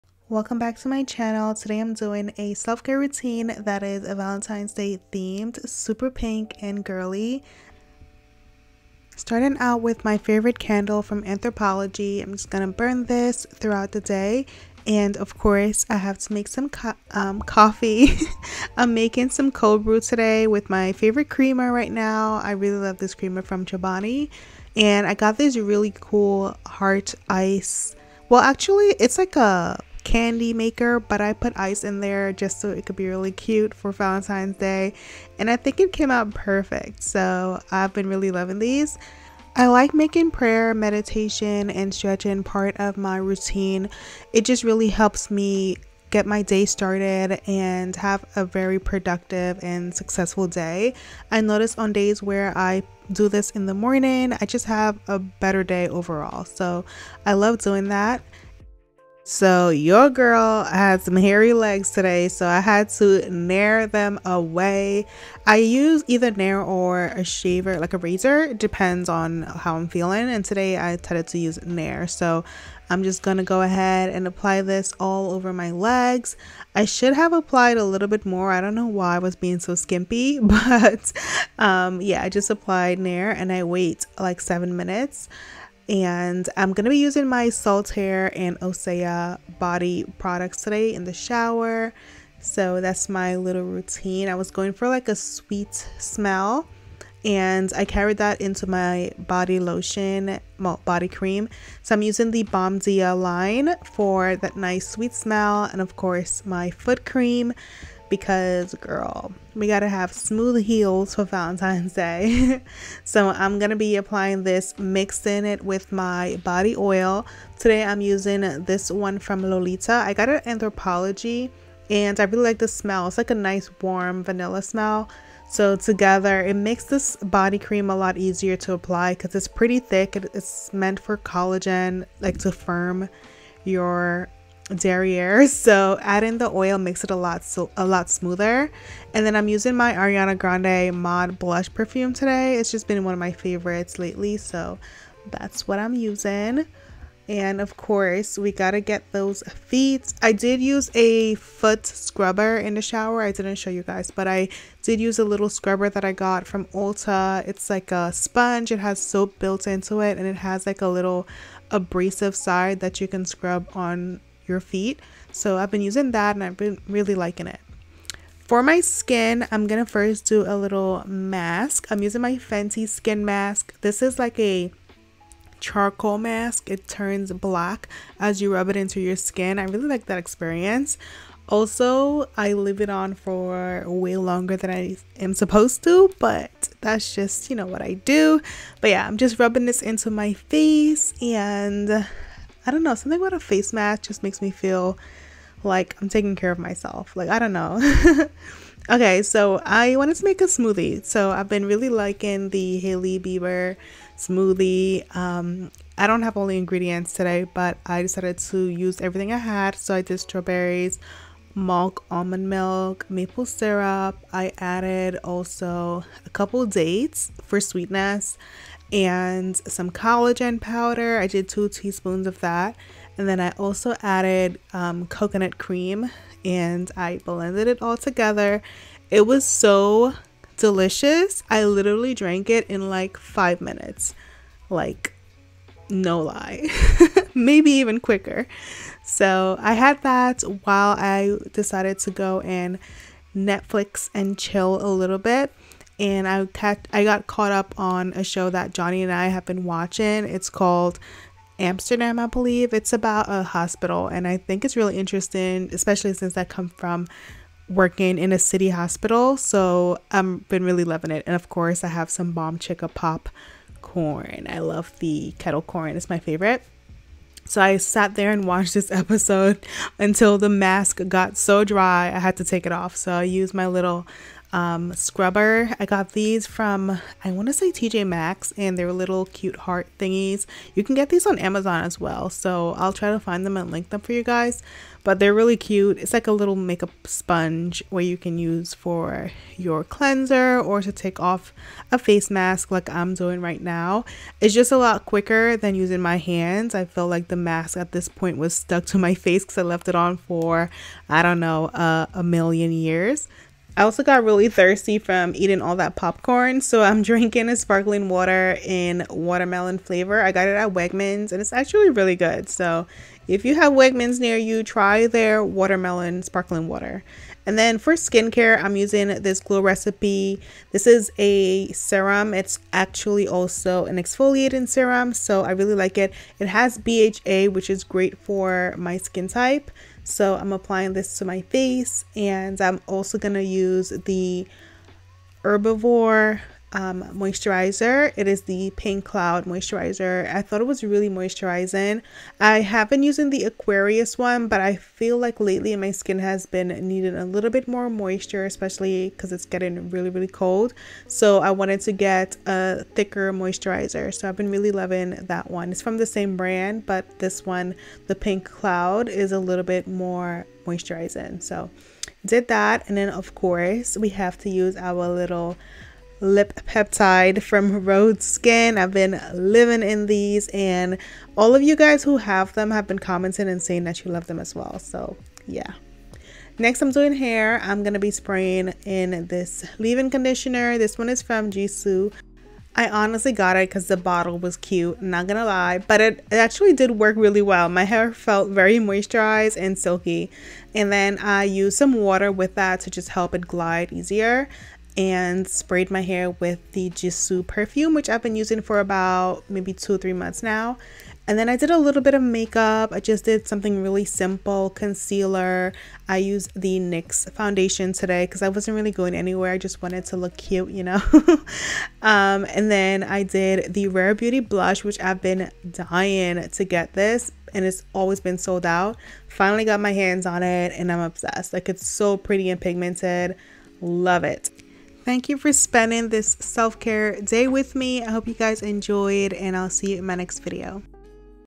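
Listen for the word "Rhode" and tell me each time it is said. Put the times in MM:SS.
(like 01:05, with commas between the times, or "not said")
06:07.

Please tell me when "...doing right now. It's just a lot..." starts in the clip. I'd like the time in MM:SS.
04:53.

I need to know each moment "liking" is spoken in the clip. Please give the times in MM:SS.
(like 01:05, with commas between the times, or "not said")
02:47, 03:21.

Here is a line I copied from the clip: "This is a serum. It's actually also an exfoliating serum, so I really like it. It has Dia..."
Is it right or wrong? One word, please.
wrong.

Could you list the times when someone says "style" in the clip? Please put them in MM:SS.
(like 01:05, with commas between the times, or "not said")
not said.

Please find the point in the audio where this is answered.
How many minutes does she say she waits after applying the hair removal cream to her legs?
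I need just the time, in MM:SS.
01:24.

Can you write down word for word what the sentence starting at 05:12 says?
So, if you have Wegmans near you, try their watermelon sparkling water.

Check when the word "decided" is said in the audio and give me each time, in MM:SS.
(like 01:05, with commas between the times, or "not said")
01:10, 03:28, 04:01.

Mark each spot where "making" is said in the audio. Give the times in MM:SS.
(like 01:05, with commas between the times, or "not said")
00:18, 00:39.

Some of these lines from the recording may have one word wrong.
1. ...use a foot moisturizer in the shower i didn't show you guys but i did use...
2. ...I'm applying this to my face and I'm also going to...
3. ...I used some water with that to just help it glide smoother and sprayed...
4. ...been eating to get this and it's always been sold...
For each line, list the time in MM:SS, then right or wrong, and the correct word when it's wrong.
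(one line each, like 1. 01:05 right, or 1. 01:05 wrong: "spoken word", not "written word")
1. 02:30 wrong: "scrubber", not "moisturizer"
2. 05:30 right
3. 06:31 wrong: "easier", not "smoother"
4. 06:55 wrong: "dying", not "eating".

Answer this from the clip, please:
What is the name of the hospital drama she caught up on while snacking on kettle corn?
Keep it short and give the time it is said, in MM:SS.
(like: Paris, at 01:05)
Amsterdam, at 04:11.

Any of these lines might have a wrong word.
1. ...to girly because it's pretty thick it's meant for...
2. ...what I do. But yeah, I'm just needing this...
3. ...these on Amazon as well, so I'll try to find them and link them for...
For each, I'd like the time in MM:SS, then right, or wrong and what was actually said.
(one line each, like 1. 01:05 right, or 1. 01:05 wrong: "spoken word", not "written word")
1. 02:08 wrong: "apply", not "girly"
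2. 03:07 wrong: "rubbing", not "needing"
3. 04:41 right.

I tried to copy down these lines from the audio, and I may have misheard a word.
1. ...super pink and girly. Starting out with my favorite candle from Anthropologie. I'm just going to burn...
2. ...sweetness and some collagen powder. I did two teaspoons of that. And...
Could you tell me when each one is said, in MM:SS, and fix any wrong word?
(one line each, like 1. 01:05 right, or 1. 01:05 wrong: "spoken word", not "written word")
1. 00:05 right
2. 03:37 right.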